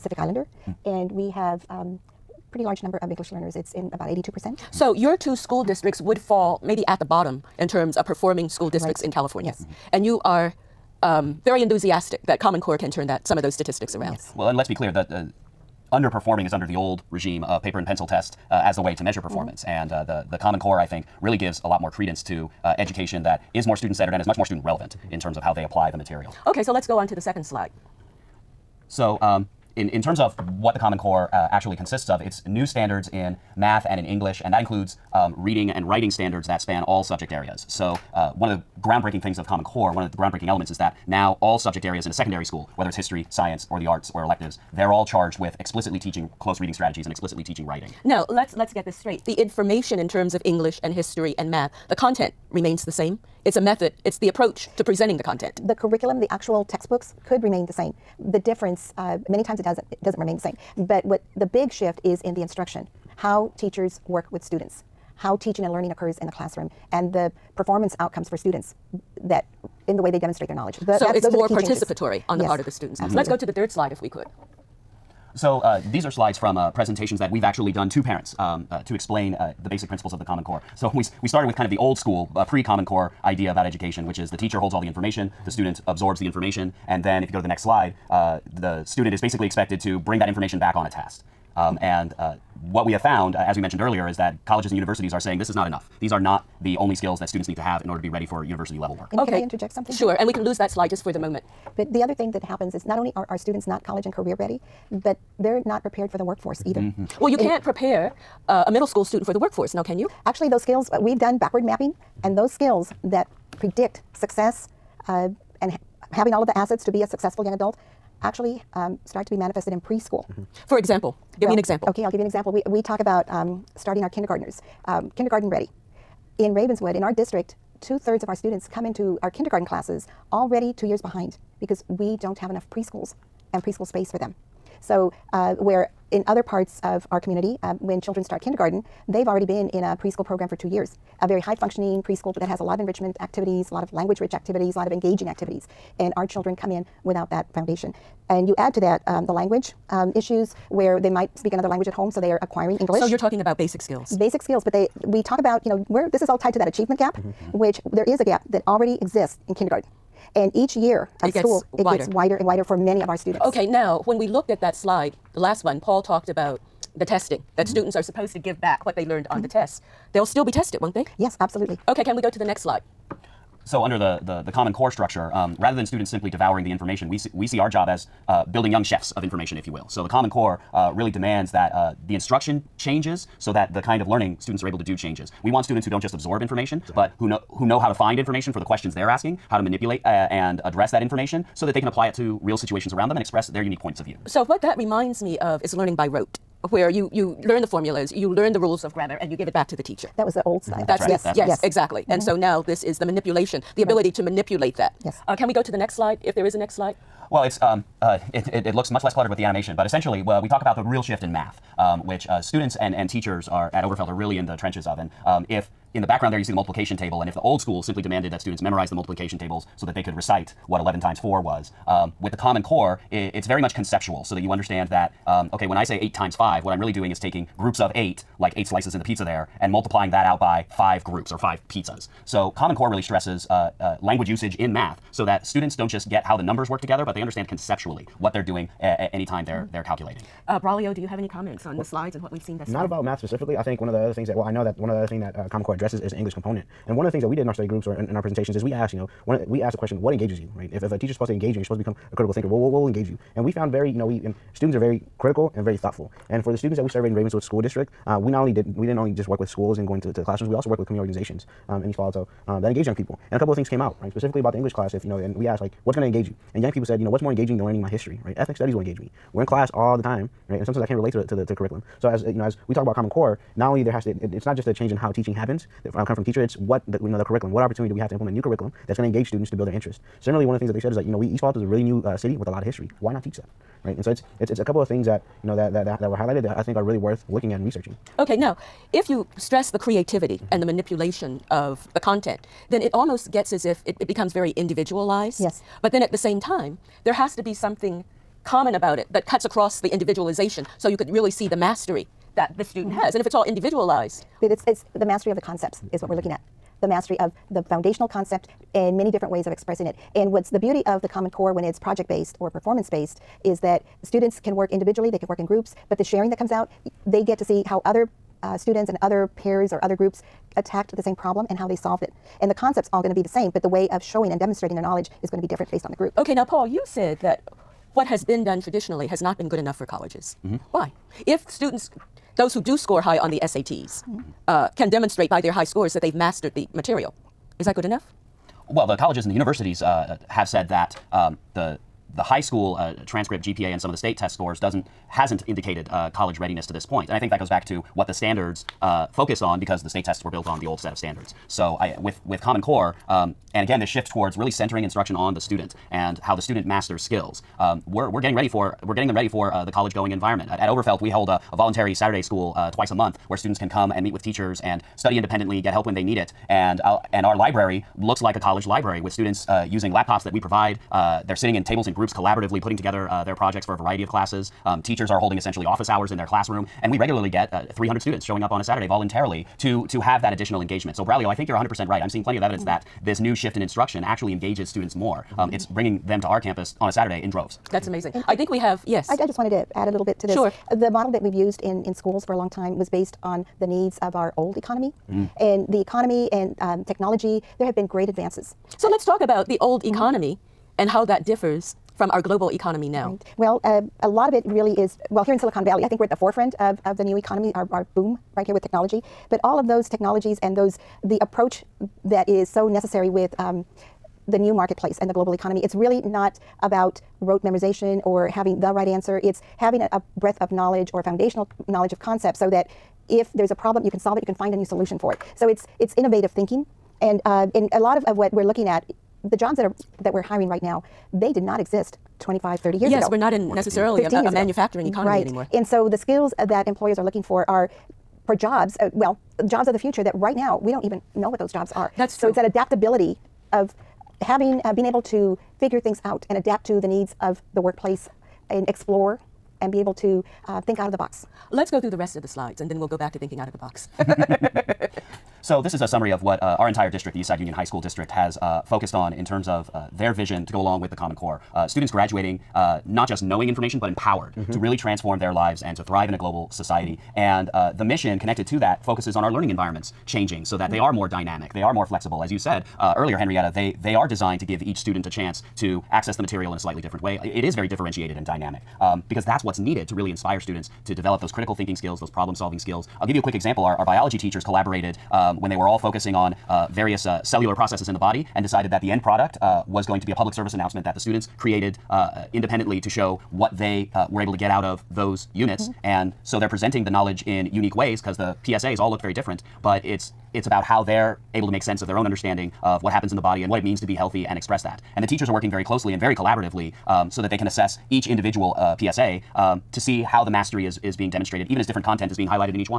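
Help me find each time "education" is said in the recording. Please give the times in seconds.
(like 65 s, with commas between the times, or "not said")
22 s, 83 s.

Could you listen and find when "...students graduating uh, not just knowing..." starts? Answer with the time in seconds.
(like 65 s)
461 s.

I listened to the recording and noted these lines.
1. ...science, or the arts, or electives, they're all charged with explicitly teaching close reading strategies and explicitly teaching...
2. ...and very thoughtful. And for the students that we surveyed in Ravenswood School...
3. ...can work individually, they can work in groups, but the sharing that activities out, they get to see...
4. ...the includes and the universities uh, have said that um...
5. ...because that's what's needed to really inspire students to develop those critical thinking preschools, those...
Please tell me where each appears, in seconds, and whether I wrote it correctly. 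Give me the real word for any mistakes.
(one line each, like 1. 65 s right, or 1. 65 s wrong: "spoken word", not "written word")
1. 43 s right
2. 255 s right
3. 314 s wrong: "comes", not "activities"
4. 338 s wrong: "colleges", not "includes"
5. 479 s wrong: "skills", not "preschools".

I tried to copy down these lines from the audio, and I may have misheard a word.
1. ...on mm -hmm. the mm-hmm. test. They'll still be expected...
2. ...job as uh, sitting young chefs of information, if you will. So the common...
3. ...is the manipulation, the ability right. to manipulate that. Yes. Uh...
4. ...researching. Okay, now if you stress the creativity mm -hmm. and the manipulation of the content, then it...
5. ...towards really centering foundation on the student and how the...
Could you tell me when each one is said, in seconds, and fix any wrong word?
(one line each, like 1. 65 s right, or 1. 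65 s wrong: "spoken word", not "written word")
1. 169 s wrong: "tested", not "expected"
2. 177 s wrong: "building", not "sitting"
3. 202 s right
4. 287 s right
5. 354 s wrong: "instruction", not "foundation".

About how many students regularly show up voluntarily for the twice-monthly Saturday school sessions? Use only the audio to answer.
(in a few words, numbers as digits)
300.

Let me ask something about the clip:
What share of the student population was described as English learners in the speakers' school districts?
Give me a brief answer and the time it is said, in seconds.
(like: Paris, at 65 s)
82%, at 4 s.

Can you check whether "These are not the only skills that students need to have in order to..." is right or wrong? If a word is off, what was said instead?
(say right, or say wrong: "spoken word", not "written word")
right.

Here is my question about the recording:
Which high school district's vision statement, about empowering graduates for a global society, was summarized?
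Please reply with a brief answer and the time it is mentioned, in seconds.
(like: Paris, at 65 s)
Eastside Union High School District, at 457 s.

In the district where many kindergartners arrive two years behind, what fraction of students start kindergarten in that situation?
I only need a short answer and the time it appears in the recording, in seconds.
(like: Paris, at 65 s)
two thirds, at 127 s.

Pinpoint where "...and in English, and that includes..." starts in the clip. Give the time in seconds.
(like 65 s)
33 s.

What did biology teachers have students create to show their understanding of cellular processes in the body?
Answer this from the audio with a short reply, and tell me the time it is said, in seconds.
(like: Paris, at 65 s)
public service announcement, at 490 s.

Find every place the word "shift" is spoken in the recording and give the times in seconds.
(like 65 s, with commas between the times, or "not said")
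61 s, 211 s, 353 s, 383 s.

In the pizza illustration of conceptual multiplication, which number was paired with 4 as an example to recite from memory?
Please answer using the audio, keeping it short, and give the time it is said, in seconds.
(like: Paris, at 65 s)
11, at 220 s.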